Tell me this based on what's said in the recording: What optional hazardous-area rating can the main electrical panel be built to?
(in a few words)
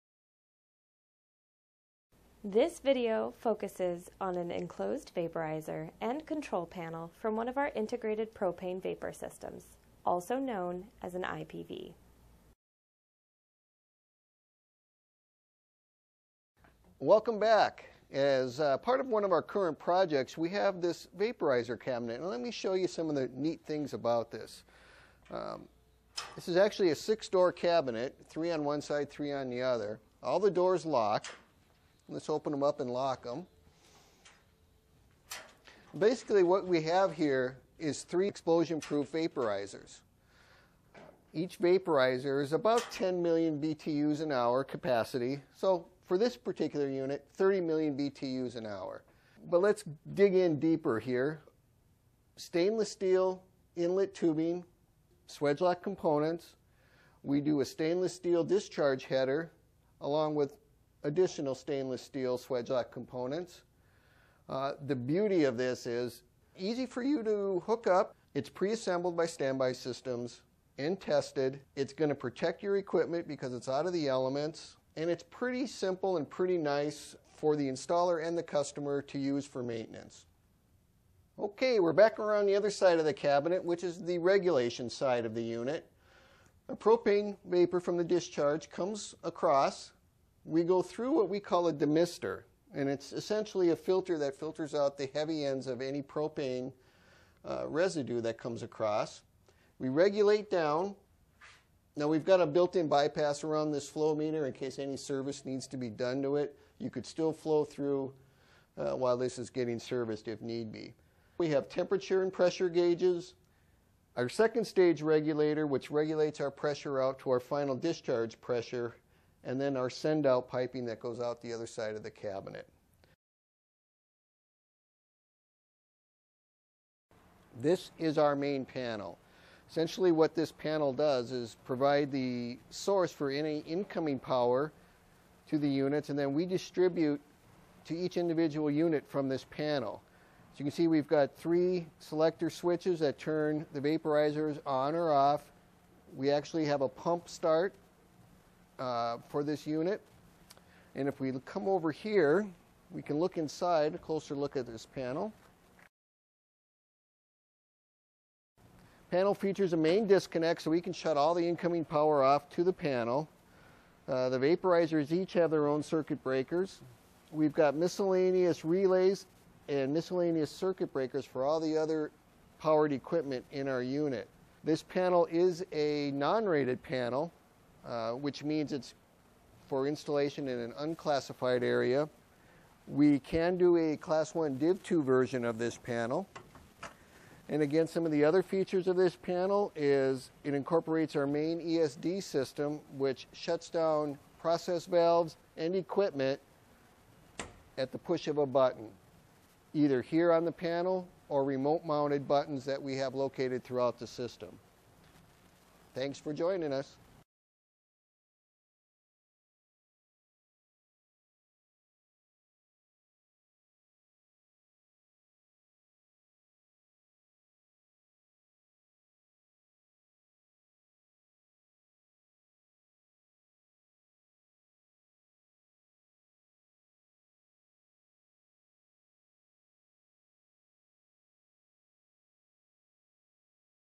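Class 1 Div 2.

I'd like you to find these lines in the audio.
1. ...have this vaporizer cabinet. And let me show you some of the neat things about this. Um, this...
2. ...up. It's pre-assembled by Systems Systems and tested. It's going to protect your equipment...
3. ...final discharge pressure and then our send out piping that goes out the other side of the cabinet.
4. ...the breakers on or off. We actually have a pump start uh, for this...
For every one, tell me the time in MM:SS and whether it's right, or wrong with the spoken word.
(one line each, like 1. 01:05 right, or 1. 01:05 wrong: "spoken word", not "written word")
1. 00:20 right
2. 01:07 wrong: "Standby", not "Systems"
3. 01:57 right
4. 02:23 wrong: "vaporizers", not "breakers".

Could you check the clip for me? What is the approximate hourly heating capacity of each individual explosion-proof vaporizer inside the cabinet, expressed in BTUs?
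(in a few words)
10 million BTUs.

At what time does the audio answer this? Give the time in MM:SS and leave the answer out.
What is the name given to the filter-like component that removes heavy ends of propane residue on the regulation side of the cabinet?
01:31.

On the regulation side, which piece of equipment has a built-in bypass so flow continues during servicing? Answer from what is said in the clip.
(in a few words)
flow meter.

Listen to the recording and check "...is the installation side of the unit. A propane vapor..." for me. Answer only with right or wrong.
wrong.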